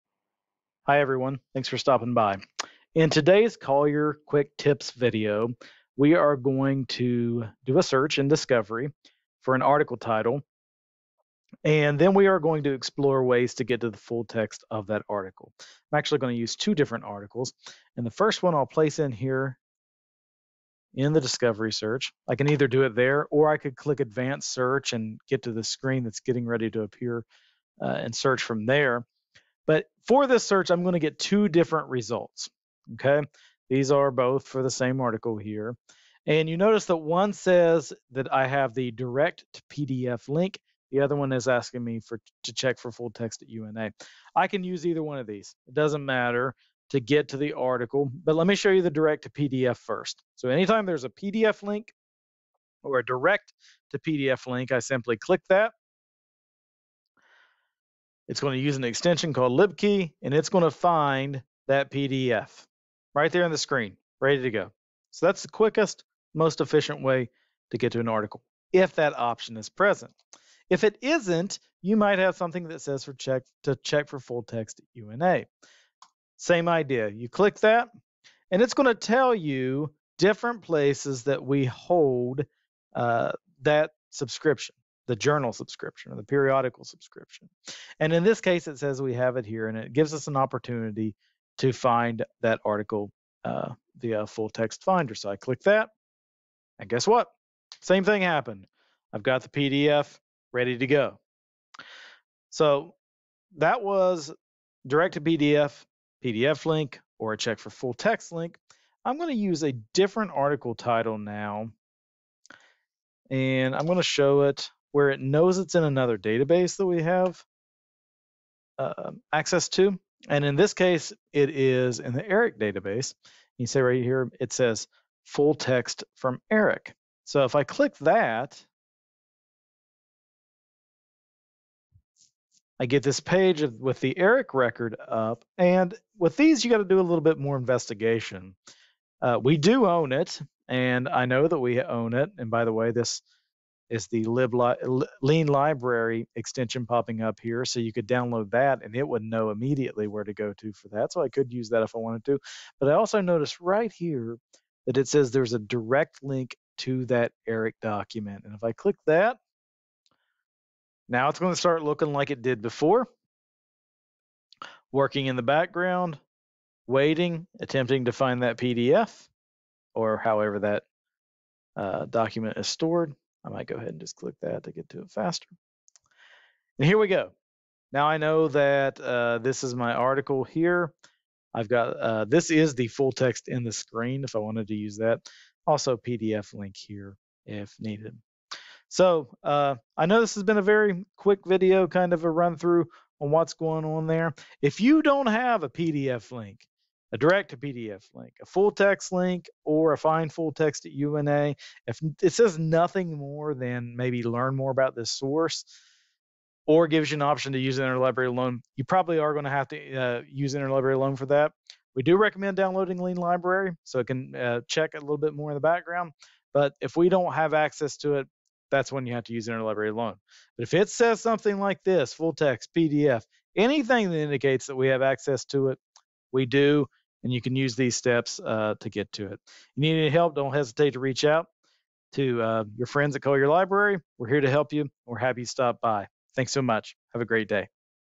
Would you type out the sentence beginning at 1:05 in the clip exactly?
So that's the quickest, most efficient way to get to an article if that option is present.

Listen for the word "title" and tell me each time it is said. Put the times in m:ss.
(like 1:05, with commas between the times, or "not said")
0:09, 1:50.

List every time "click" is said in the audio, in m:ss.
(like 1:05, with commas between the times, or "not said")
0:23, 0:55, 1:17, 1:35, 2:07, 2:38, 2:54.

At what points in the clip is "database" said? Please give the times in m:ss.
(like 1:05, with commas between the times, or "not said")
1:56, 2:02.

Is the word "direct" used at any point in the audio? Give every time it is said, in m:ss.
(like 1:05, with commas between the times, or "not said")
0:38, 0:48, 0:53, 1:44, 2:35, 3:17.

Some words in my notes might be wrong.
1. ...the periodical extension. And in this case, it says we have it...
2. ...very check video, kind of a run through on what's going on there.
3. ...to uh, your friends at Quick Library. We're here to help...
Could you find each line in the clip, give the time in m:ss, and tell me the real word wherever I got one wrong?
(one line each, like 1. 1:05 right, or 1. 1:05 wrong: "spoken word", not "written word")
1. 1:26 wrong: "subscription", not "extension"
2. 3:10 wrong: "quick", not "check"
3. 3:52 wrong: "Collier", not "Quick".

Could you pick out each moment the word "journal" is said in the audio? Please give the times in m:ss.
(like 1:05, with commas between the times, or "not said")
1:25.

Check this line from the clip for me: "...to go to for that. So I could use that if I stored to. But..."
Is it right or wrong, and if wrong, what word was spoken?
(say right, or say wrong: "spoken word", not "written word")
wrong: "wanted", not "stored".